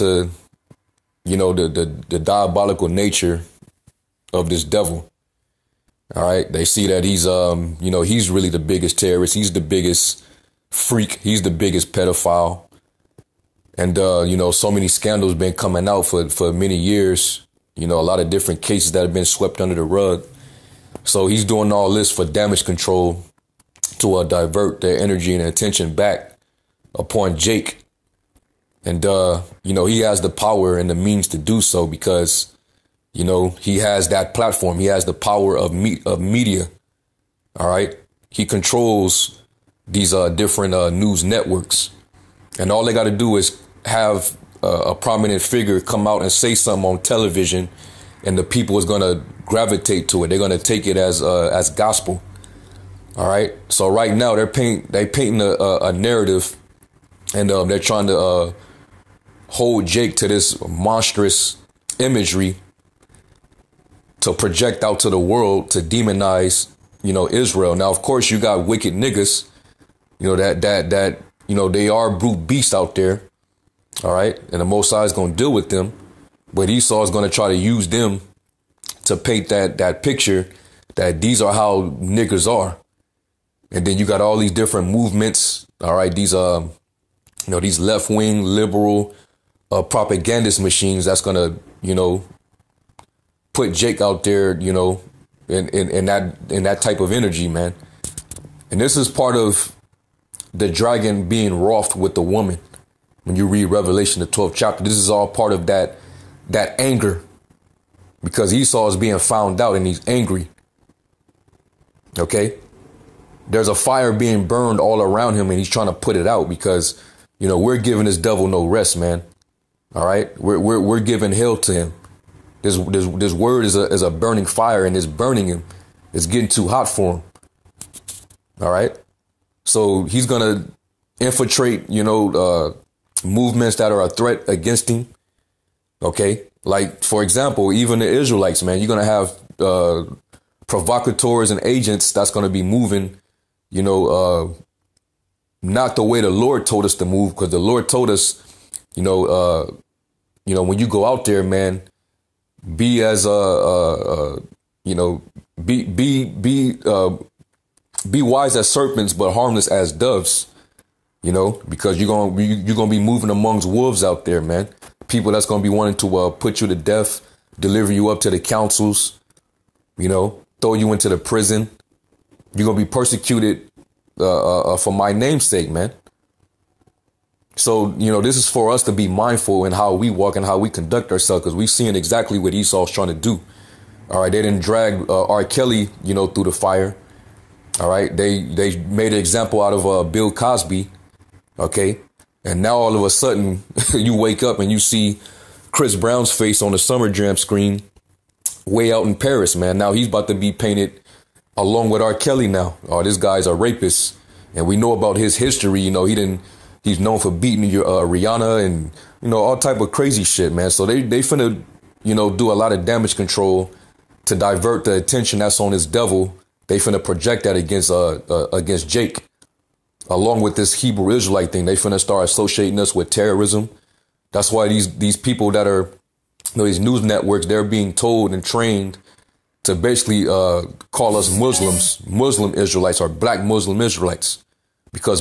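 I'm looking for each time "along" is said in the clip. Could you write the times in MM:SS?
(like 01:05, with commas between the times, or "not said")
03:21, 03:40.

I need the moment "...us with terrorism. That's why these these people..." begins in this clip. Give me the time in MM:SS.
03:42.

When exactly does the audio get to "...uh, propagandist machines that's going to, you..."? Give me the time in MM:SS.
01:29.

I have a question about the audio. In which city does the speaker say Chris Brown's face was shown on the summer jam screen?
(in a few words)
Paris.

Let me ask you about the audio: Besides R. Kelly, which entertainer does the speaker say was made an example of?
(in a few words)
Bill Cosby.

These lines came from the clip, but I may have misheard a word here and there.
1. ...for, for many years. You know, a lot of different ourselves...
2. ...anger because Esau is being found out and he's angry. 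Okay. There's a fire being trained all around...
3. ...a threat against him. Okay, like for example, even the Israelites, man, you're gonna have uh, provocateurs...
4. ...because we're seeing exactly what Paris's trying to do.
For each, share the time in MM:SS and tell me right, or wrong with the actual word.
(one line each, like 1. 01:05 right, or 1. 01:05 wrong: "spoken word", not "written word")
1. 00:16 wrong: "cases", not "ourselves"
2. 01:46 wrong: "burned", not "trained"
3. 02:14 right
4. 03:01 wrong: "Esau", not "Paris".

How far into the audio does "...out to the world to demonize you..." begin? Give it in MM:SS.
01:04.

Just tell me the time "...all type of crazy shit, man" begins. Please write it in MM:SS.
03:29.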